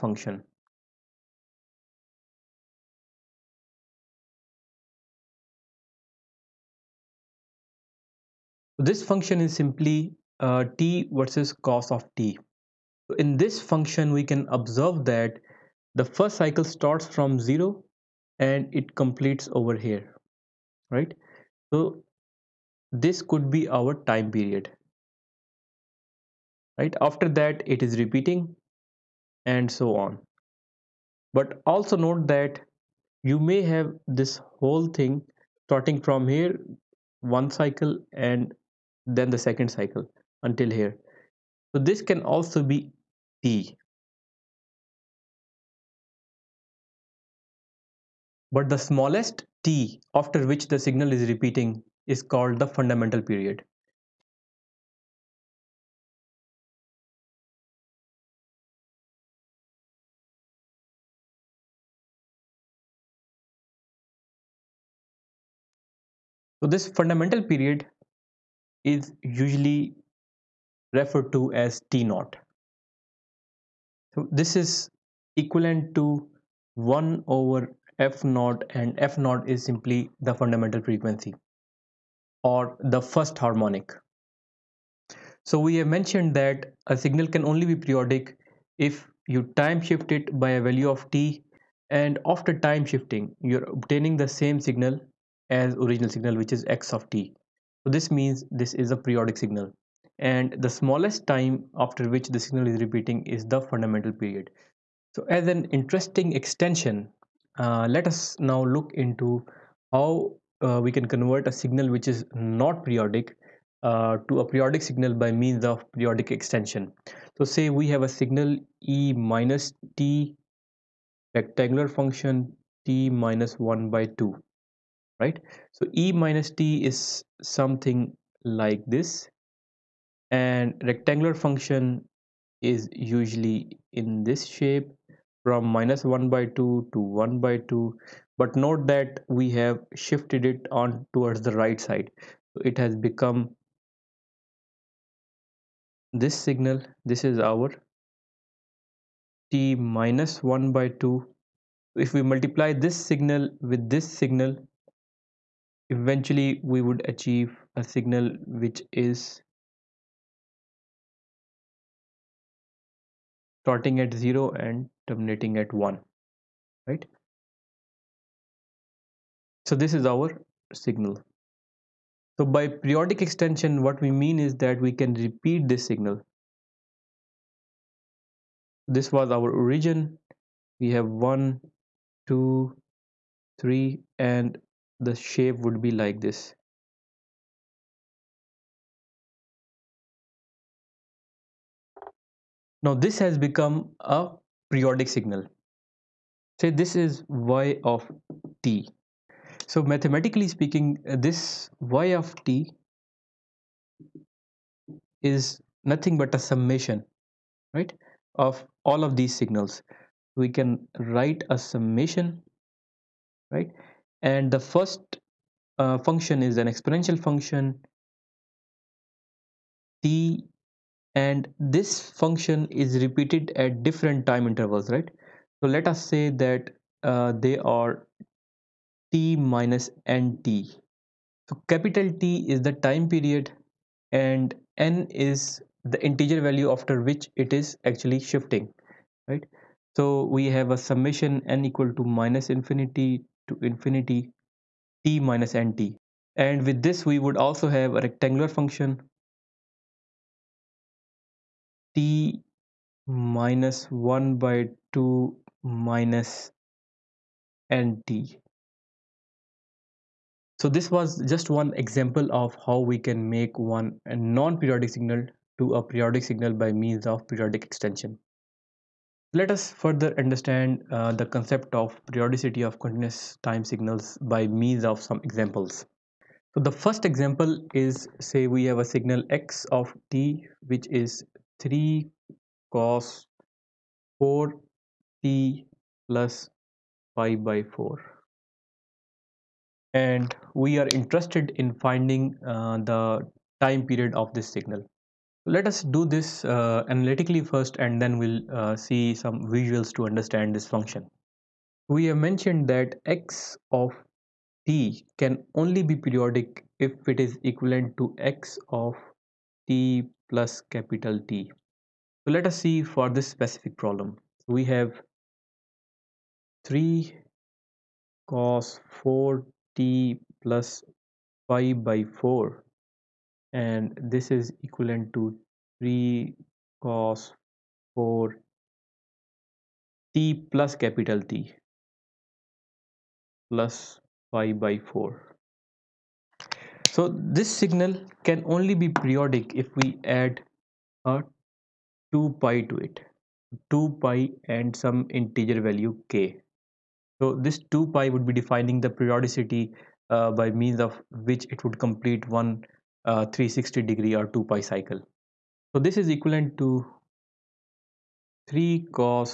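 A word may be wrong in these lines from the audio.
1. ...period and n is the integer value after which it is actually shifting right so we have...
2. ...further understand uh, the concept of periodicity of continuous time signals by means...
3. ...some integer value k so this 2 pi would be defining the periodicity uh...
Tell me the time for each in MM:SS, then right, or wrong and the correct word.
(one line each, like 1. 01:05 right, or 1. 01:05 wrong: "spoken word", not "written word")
1. 03:53 right
2. 04:29 right
3. 05:44 right.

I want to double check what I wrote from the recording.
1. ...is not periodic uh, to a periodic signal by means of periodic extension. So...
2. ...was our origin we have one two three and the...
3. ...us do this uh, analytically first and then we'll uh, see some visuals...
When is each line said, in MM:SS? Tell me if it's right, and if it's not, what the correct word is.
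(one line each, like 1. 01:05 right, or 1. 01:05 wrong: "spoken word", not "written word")
1. 01:52 right
2. 02:59 right
3. 04:55 right.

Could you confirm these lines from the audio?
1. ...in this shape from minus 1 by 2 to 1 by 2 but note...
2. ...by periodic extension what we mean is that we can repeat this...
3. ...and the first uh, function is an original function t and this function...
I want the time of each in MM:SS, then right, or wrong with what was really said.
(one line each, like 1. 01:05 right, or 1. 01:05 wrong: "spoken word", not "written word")
1. 02:13 right
2. 02:52 right
3. 03:34 wrong: "exponential", not "original".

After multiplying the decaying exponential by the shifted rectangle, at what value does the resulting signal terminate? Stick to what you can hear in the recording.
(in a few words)
1.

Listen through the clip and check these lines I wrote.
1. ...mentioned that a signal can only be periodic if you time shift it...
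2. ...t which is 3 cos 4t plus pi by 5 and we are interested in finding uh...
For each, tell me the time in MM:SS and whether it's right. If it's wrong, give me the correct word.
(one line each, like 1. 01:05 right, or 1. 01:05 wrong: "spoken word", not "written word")
1. 01:25 right
2. 04:40 wrong: "4", not "5".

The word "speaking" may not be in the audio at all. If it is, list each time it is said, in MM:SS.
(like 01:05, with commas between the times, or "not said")
03:20.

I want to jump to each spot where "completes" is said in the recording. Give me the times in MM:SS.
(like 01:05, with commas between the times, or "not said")
00:18, 05:51.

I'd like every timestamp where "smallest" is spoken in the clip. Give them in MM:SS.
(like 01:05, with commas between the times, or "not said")
00:48, 01:40.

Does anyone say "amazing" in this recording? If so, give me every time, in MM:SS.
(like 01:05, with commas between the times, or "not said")
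not said.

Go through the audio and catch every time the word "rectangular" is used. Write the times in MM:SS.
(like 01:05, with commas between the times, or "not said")
02:01, 02:10, 04:08.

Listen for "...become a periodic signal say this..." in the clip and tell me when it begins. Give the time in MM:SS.
03:13.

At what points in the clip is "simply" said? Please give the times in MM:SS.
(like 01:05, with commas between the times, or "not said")
00:09, 01:19.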